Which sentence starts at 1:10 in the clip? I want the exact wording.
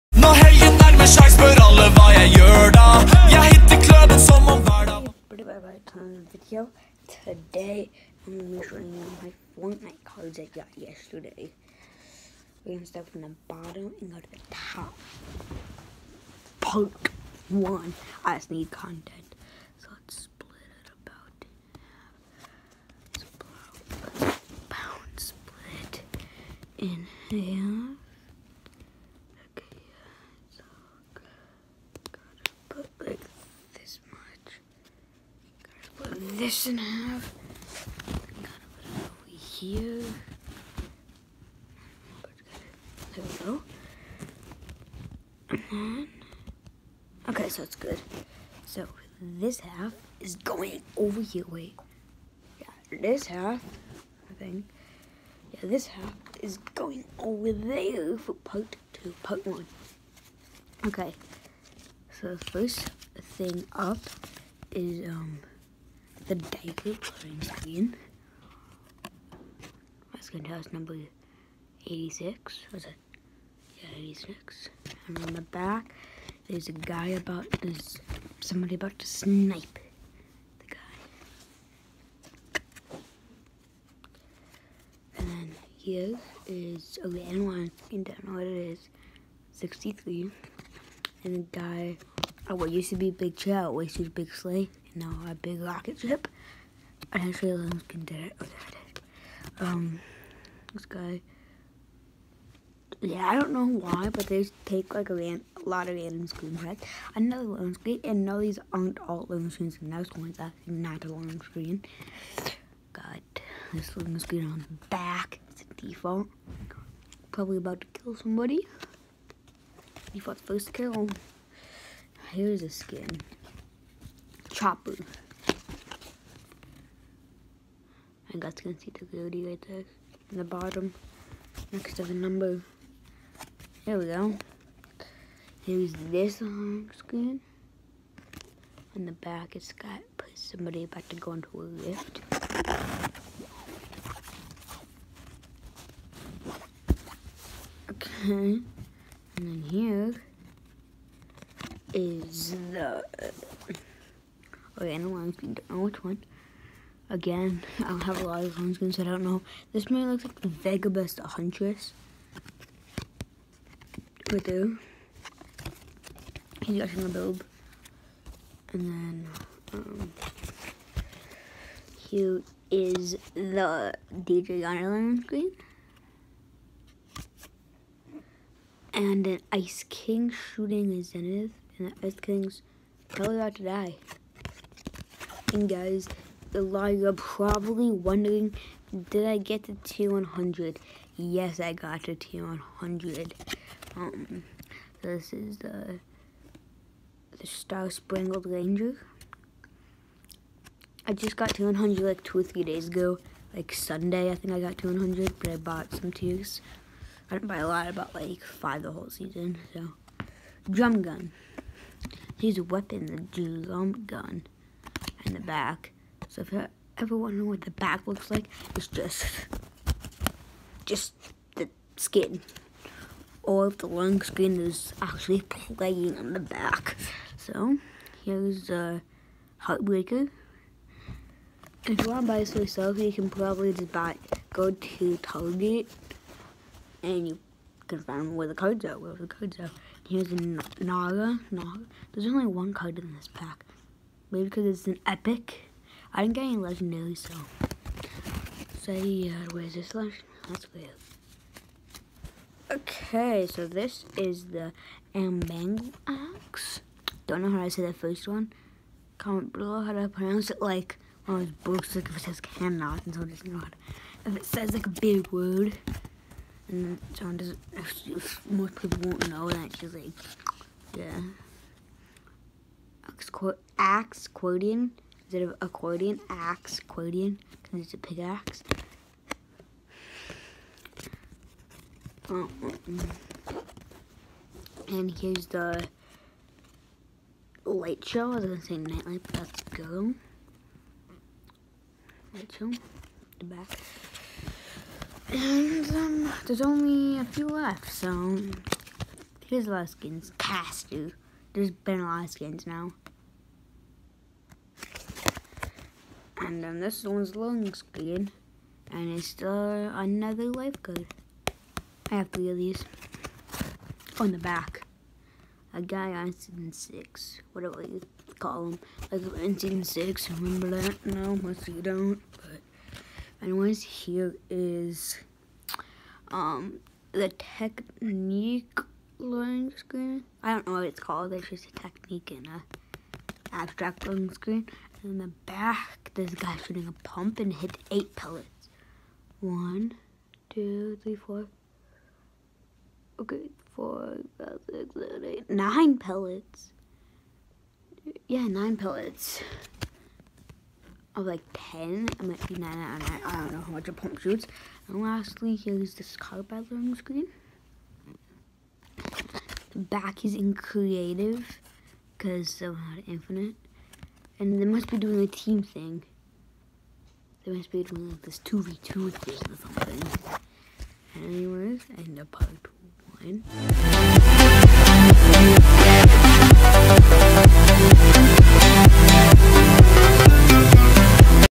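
Let's go to us number 86.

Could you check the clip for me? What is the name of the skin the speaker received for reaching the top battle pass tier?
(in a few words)
Star Spangled Ranger.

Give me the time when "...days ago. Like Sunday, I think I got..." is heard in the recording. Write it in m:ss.
3:22.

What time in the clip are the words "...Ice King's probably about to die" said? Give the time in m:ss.
3:02.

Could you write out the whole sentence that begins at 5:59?
The back is in creative because they're not infinite.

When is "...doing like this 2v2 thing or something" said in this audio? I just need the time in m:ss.
6:07.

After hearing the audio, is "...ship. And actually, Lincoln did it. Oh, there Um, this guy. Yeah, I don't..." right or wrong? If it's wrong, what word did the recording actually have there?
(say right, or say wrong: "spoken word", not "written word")
right.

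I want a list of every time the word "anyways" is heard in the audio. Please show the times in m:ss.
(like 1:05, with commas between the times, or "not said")
5:23, 6:11.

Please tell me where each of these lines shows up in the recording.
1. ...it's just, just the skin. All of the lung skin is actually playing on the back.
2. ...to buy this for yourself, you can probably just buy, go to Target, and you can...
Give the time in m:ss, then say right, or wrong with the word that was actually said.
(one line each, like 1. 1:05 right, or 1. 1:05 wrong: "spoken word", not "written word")
1. 3:38 right
2. 3:52 right.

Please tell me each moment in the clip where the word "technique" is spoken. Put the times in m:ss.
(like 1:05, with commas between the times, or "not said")
5:27, 5:31.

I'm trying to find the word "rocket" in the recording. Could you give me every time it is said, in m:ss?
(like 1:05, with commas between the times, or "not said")
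1:35.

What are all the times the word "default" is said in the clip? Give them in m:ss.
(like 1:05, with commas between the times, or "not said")
1:55, 2:00.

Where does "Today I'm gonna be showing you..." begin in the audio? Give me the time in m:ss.
0:07.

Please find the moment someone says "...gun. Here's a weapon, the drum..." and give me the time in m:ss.
3:31.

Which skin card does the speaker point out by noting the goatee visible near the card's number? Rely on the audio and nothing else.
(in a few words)
Chopper.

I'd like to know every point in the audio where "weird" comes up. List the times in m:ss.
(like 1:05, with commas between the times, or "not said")
4:10.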